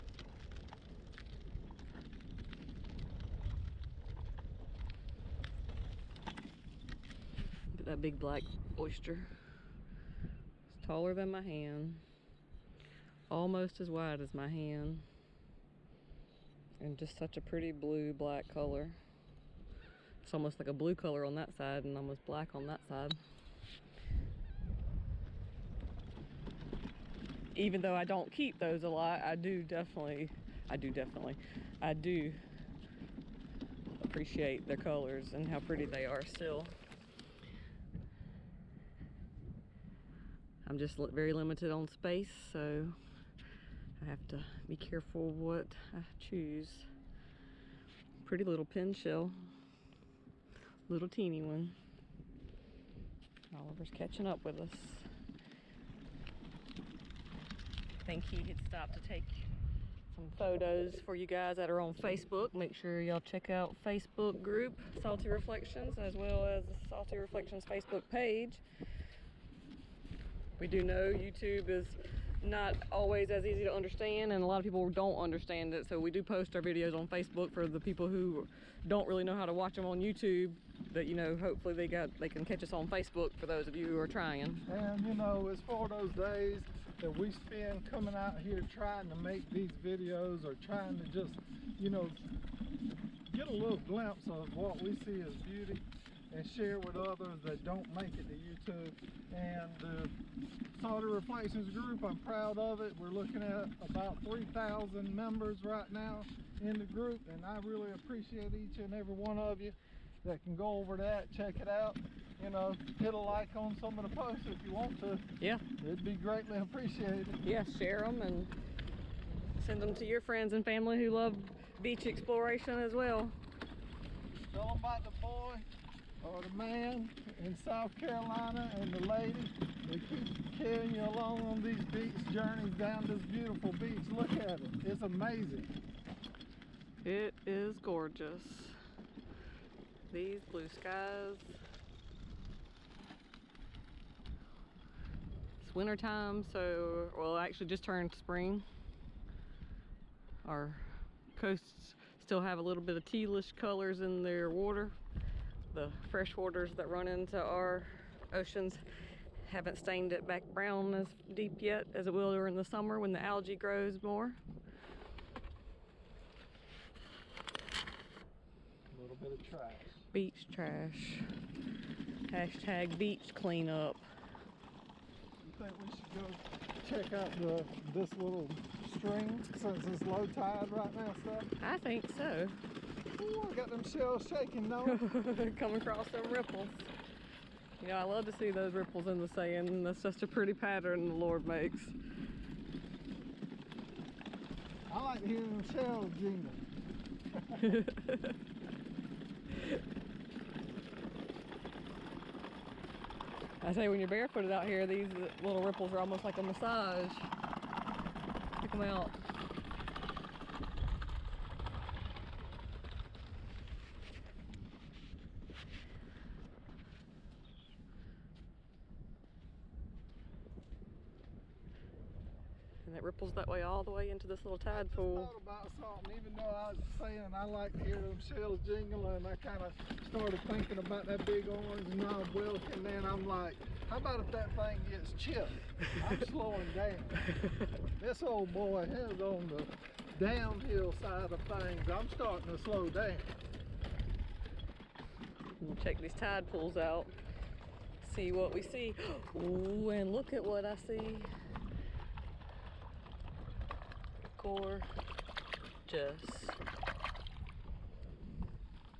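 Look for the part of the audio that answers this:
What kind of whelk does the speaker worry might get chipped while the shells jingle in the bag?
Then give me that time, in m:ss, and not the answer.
3:51.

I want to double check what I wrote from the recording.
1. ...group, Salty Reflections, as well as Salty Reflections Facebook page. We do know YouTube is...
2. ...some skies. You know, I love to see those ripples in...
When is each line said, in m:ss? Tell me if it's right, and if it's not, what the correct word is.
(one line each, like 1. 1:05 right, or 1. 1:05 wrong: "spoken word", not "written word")
1. 1:04 right
2. 3:06 wrong: "ripples", not "skies".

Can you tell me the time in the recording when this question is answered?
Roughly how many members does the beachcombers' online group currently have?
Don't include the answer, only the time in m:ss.
1:44.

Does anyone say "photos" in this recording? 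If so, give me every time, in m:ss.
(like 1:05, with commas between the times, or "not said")
1:00.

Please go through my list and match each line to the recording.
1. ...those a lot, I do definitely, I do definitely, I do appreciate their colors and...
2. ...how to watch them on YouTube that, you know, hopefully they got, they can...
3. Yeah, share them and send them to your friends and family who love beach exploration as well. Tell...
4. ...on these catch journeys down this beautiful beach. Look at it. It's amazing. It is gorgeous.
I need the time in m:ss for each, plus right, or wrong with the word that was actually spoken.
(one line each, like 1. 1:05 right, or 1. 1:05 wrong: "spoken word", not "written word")
1. 0:28 right
2. 1:19 right
3. 1:57 right
4. 2:11 wrong: "beach", not "catch".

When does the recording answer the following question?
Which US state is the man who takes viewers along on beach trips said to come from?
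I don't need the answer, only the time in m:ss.
2:07.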